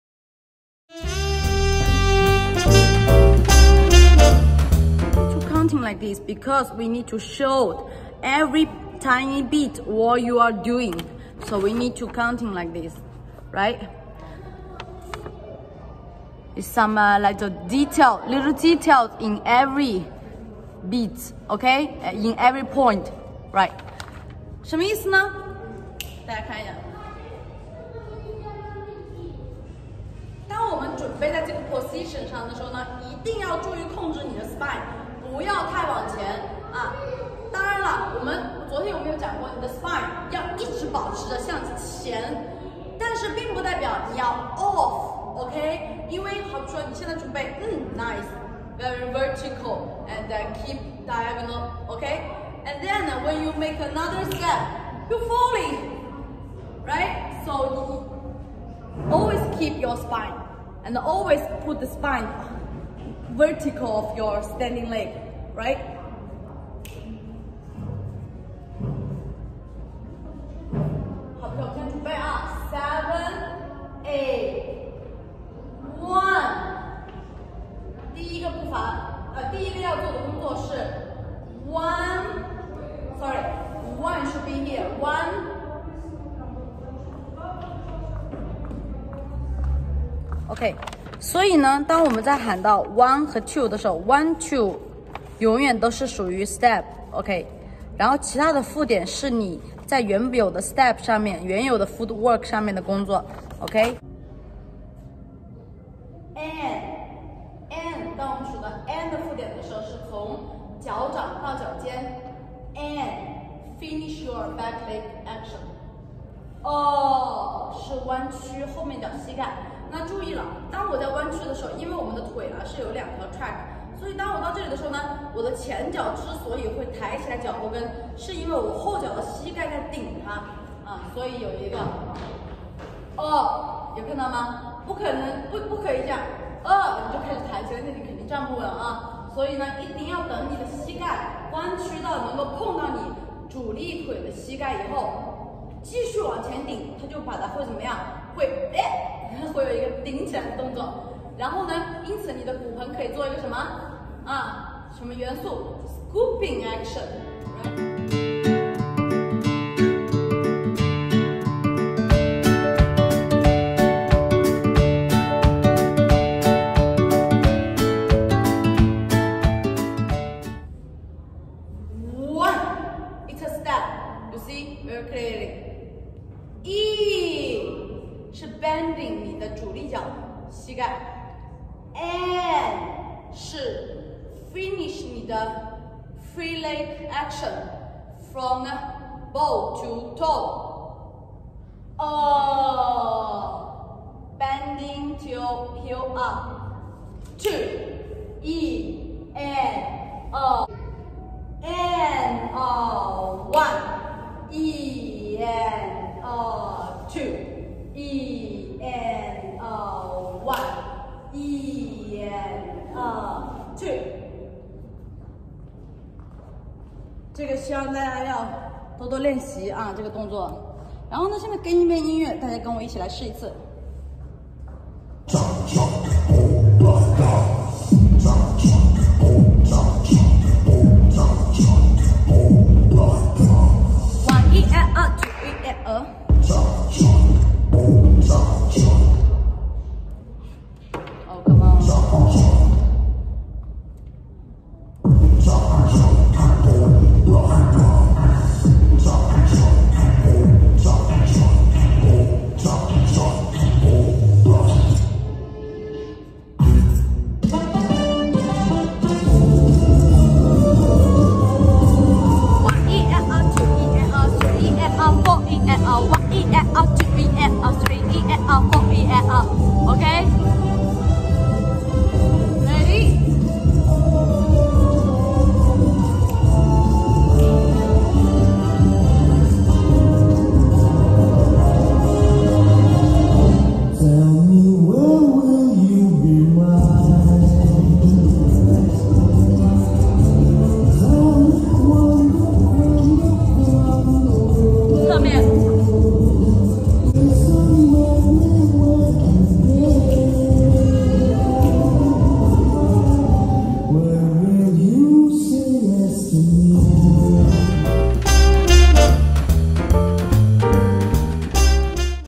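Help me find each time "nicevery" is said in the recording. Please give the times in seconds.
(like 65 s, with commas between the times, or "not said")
47 s.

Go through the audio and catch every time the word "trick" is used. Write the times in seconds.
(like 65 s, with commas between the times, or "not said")
not said.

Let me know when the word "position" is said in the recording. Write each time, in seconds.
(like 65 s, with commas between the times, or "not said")
31 s.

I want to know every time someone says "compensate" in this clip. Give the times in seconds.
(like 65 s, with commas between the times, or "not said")
not said.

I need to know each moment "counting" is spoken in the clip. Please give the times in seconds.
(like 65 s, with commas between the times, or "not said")
12 s.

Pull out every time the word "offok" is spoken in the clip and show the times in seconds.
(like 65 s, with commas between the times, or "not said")
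44 s.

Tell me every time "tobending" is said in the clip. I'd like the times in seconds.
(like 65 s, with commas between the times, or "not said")
189 s.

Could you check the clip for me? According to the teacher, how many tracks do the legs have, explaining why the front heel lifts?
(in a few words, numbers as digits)
2.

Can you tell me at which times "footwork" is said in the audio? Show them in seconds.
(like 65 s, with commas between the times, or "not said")
101 s.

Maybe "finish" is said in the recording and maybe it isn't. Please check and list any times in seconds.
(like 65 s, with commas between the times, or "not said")
113 s, 184 s.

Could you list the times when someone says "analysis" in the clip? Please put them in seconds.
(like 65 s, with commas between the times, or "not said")
not said.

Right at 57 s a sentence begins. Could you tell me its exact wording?
So you always keep your spine and always put the spine.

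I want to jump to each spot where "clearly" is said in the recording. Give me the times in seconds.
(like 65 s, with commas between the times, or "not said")
175 s.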